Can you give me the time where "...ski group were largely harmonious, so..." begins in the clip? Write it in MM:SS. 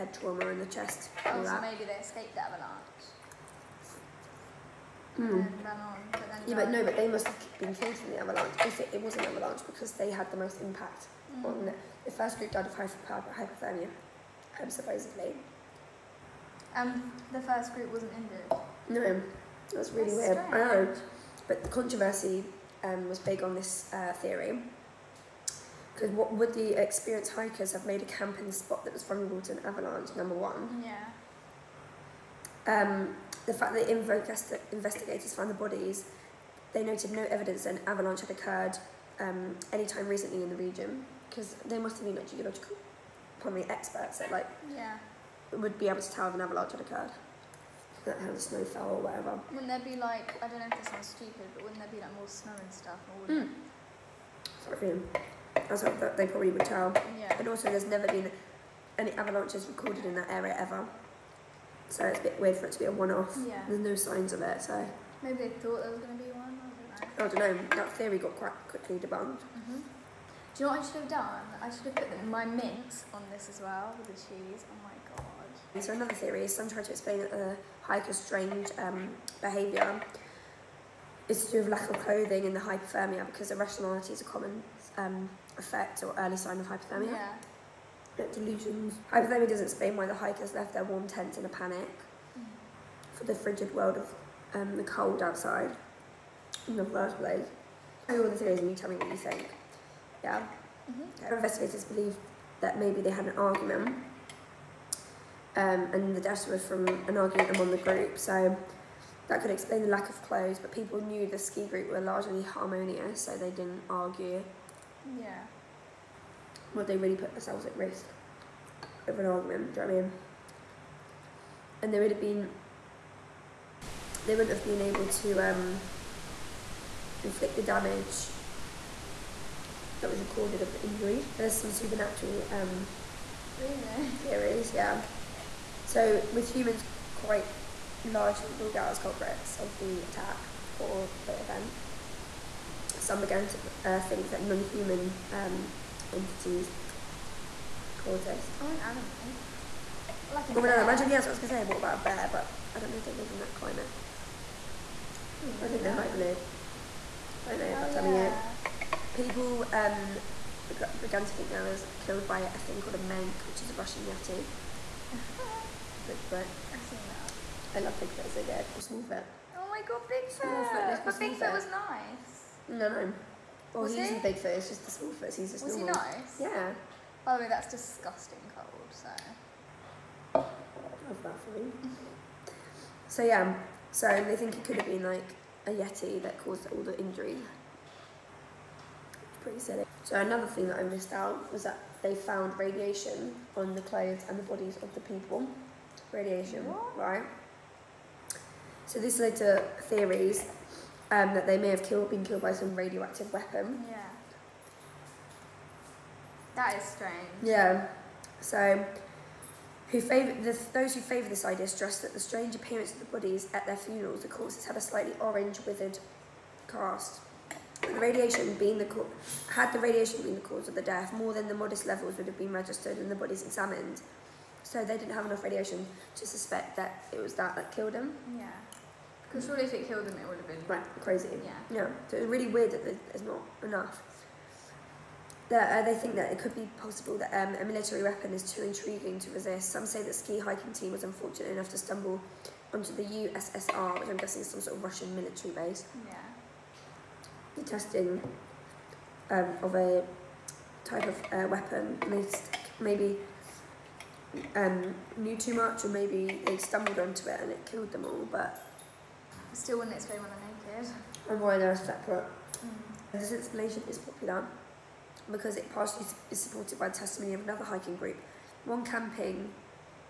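01:51.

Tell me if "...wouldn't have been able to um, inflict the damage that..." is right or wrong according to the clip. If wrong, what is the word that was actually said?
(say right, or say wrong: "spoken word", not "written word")
right.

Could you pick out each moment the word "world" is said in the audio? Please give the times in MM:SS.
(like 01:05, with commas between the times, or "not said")
01:33.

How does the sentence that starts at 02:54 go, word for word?
the big foot, it's just the small foot.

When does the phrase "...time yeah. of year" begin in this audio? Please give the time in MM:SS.
02:38.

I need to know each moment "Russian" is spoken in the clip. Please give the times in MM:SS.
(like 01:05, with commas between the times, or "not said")
02:43, 04:04.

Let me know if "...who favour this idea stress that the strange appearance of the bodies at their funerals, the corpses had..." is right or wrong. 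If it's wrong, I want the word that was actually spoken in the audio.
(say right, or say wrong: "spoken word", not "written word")
right.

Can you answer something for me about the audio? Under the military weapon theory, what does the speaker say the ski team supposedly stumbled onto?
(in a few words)
The USSR.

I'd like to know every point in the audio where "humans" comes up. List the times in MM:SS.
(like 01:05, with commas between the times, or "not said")
02:16, 02:24.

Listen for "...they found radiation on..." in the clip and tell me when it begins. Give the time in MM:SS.
03:12.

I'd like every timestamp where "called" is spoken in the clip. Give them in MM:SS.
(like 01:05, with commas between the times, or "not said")
02:27, 02:42.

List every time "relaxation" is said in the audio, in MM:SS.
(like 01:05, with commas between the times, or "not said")
not said.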